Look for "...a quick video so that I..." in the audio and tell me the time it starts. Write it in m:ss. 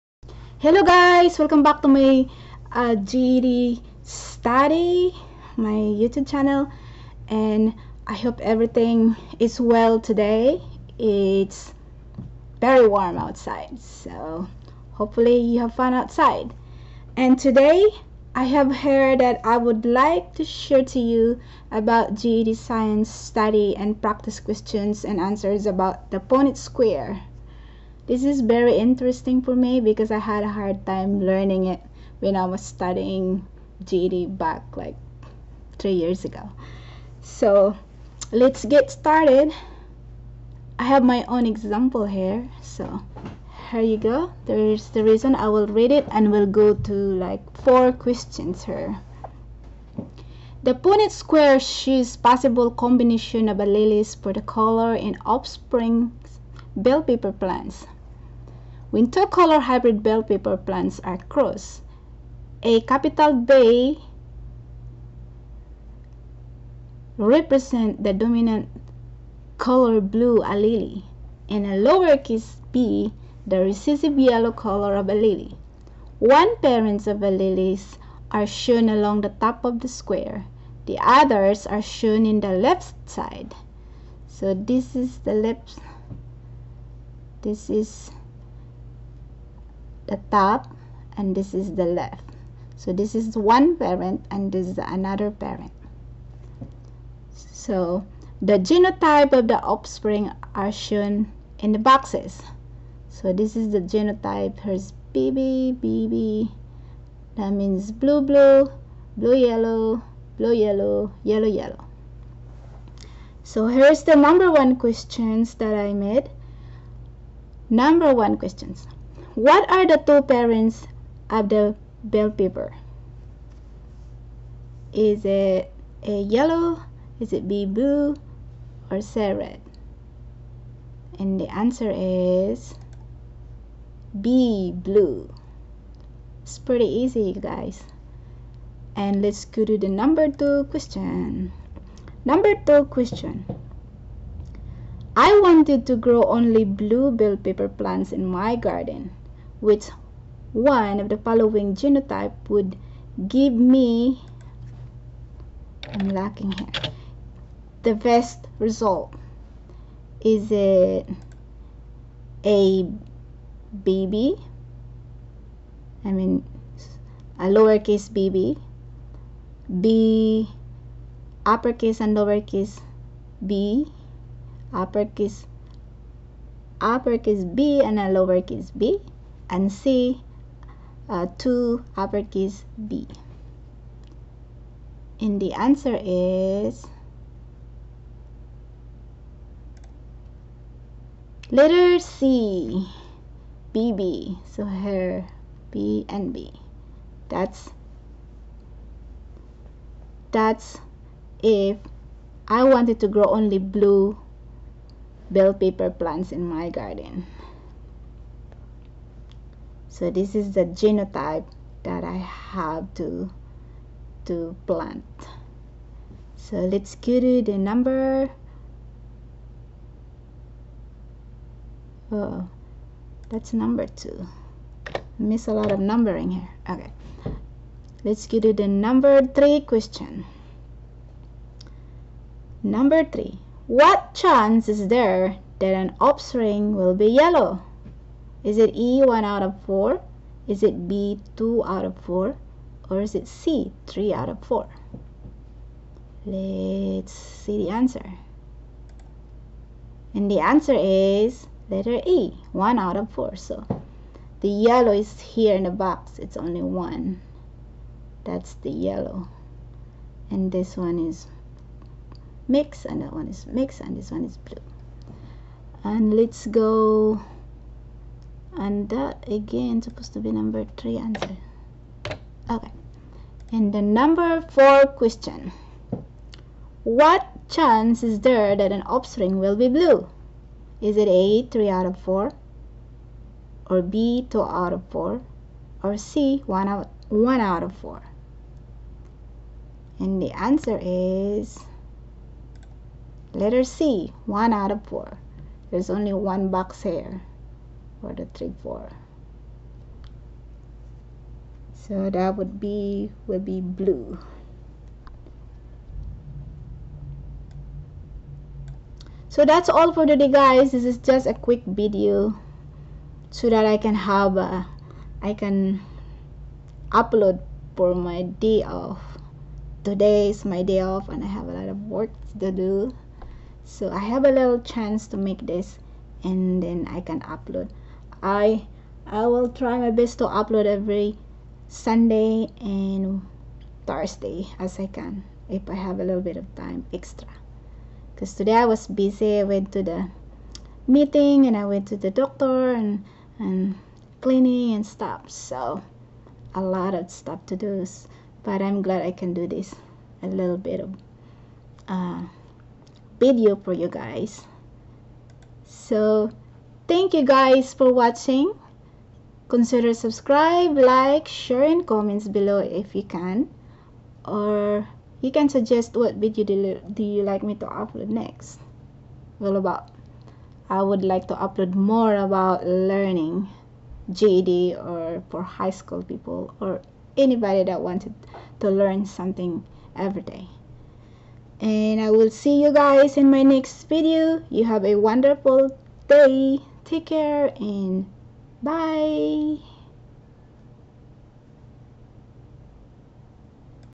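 5:11.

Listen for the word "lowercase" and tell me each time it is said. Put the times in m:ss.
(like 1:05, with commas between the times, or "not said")
1:11, 2:47, 2:52, 2:58.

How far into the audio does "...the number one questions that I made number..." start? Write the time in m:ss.
1:54.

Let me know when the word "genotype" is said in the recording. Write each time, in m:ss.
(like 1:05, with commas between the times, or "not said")
1:38, 1:43, 2:31, 3:30.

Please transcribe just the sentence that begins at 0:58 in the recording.
Winter-color hybrid bell pepper plants are crossed.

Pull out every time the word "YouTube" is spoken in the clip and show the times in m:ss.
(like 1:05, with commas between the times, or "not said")
0:05.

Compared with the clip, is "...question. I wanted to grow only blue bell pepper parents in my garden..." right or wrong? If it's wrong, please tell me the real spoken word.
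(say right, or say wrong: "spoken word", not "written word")
wrong: "plants", not "parents".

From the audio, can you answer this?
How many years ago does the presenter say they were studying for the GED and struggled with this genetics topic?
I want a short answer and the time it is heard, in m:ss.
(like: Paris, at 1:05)
3, at 0:35.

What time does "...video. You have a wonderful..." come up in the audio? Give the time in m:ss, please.
6:23.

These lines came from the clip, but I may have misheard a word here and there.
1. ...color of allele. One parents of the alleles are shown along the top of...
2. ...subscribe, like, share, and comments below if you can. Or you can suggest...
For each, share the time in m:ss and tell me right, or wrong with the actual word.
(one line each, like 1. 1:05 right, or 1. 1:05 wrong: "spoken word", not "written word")
1. 1:14 right
2. 5:59 right.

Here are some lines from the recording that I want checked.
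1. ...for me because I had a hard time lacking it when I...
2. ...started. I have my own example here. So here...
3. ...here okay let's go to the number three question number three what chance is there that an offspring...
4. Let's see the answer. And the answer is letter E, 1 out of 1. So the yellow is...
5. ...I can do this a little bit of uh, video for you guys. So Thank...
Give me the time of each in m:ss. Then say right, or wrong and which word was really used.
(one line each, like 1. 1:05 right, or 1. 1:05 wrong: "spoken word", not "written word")
1. 0:29 wrong: "learning", not "lacking"
2. 0:38 right
3. 3:46 right
4. 4:06 wrong: "4", not "1"
5. 5:49 right.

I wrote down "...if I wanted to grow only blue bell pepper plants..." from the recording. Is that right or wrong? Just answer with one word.
right.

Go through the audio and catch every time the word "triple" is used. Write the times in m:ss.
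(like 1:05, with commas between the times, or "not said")
not said.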